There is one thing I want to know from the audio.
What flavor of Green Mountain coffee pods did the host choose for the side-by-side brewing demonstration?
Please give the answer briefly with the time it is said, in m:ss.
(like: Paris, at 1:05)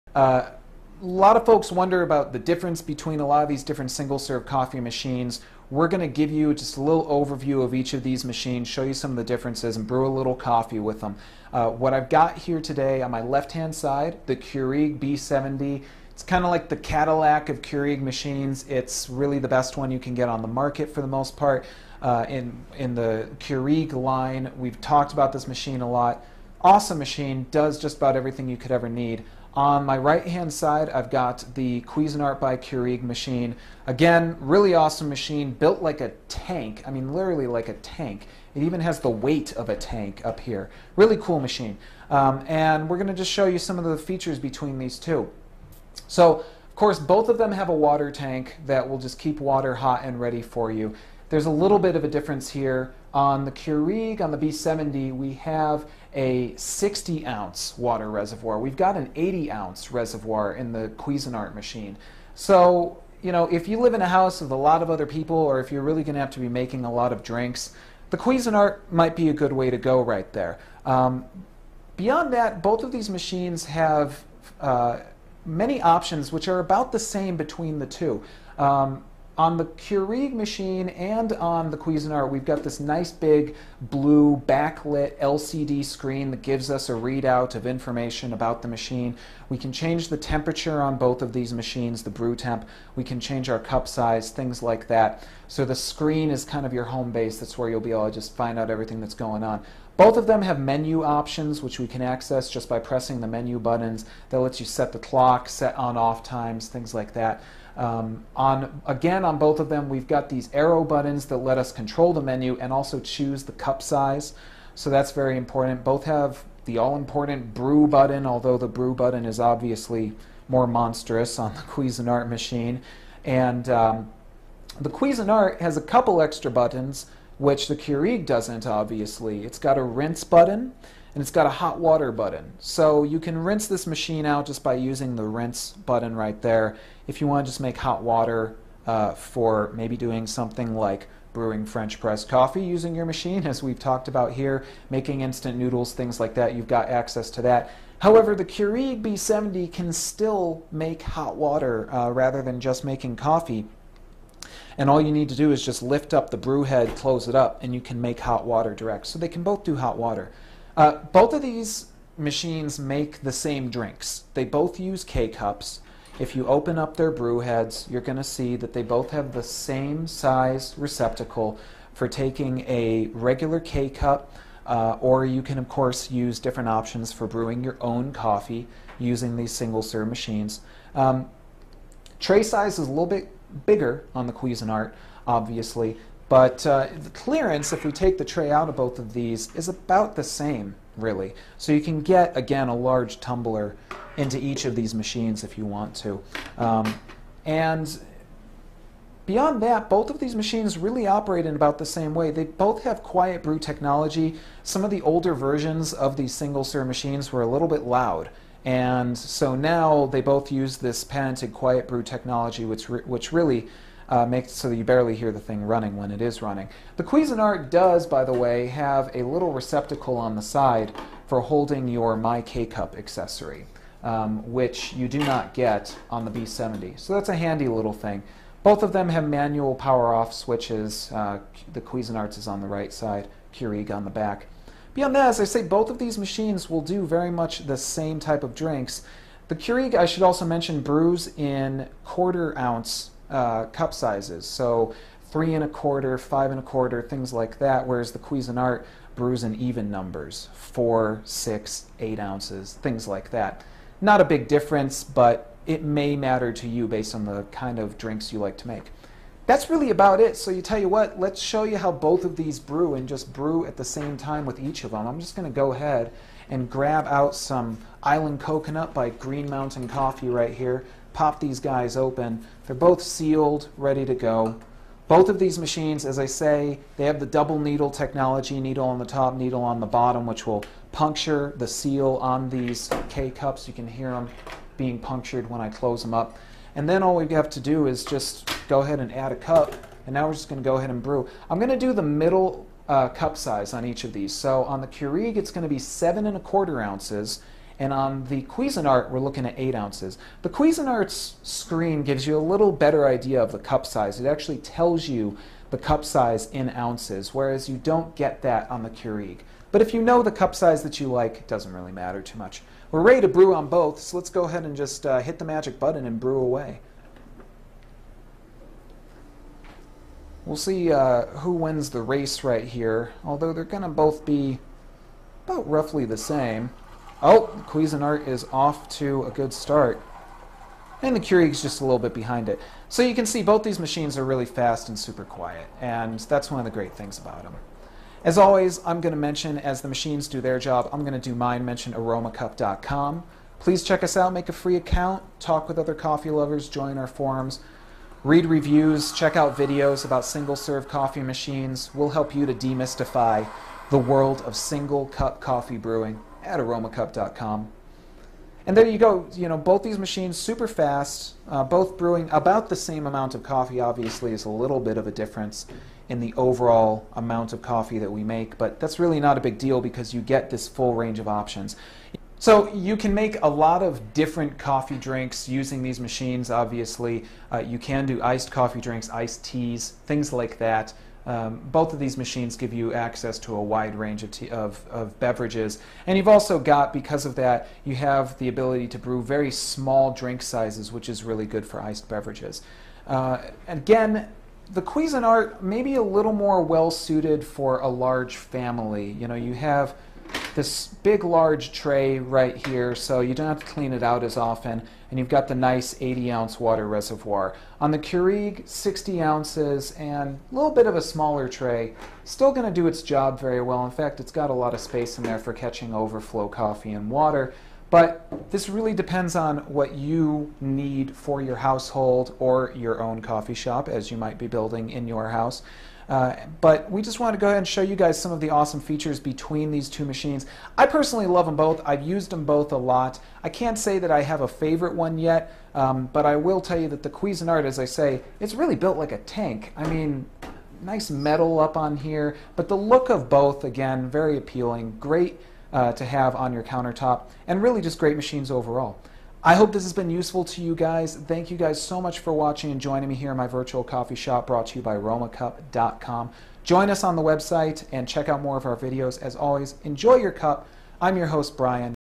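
Island Coconut, at 4:28.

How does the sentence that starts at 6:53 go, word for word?
In fact, it's got a lot of space in there for catching overflow coffee and water.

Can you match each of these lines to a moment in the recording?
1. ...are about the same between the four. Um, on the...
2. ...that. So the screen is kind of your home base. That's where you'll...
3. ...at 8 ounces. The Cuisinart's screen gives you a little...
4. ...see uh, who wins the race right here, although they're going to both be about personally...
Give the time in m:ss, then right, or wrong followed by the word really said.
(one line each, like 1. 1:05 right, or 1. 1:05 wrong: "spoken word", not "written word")
1. 1:16 wrong: "two", not "four"
2. 1:34 right
3. 4:59 right
4. 5:20 wrong: "roughly", not "personally".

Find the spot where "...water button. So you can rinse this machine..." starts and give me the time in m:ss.
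2:11.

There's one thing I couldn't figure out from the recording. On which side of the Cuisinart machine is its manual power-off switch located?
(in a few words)
right side.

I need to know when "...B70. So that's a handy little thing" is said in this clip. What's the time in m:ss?
3:46.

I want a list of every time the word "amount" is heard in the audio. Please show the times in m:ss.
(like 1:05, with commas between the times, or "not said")
6:03, 6:07.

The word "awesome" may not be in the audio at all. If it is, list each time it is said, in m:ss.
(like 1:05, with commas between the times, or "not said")
0:26, 0:34, 7:08.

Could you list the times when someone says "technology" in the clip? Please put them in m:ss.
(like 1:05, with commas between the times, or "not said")
3:23, 3:32, 4:37.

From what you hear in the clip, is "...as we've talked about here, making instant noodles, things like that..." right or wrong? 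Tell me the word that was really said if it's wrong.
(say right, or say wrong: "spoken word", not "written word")
right.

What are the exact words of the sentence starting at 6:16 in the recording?
Obviously, uh, you can do iced coffee drinks, iced teas, things like that.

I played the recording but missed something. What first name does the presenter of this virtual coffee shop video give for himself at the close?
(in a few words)
Brian.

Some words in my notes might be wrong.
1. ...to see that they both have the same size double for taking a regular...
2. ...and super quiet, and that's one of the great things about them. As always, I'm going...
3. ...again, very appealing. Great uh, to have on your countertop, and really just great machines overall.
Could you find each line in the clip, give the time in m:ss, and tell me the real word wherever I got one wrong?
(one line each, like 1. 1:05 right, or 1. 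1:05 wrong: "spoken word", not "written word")
1. 2:48 wrong: "receptacle", not "double"
2. 5:34 right
3. 7:23 right.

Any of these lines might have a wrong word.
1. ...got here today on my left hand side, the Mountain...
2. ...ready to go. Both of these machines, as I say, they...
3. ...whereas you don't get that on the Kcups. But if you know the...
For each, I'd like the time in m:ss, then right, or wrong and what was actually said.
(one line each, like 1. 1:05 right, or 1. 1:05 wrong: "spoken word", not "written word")
1. 0:12 wrong: "Keurig", not "Mountain"
2. 4:33 right
3. 5:07 wrong: "Keurig", not "Kcups".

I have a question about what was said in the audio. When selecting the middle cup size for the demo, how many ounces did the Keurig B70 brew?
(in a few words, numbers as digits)
7.25 ounces.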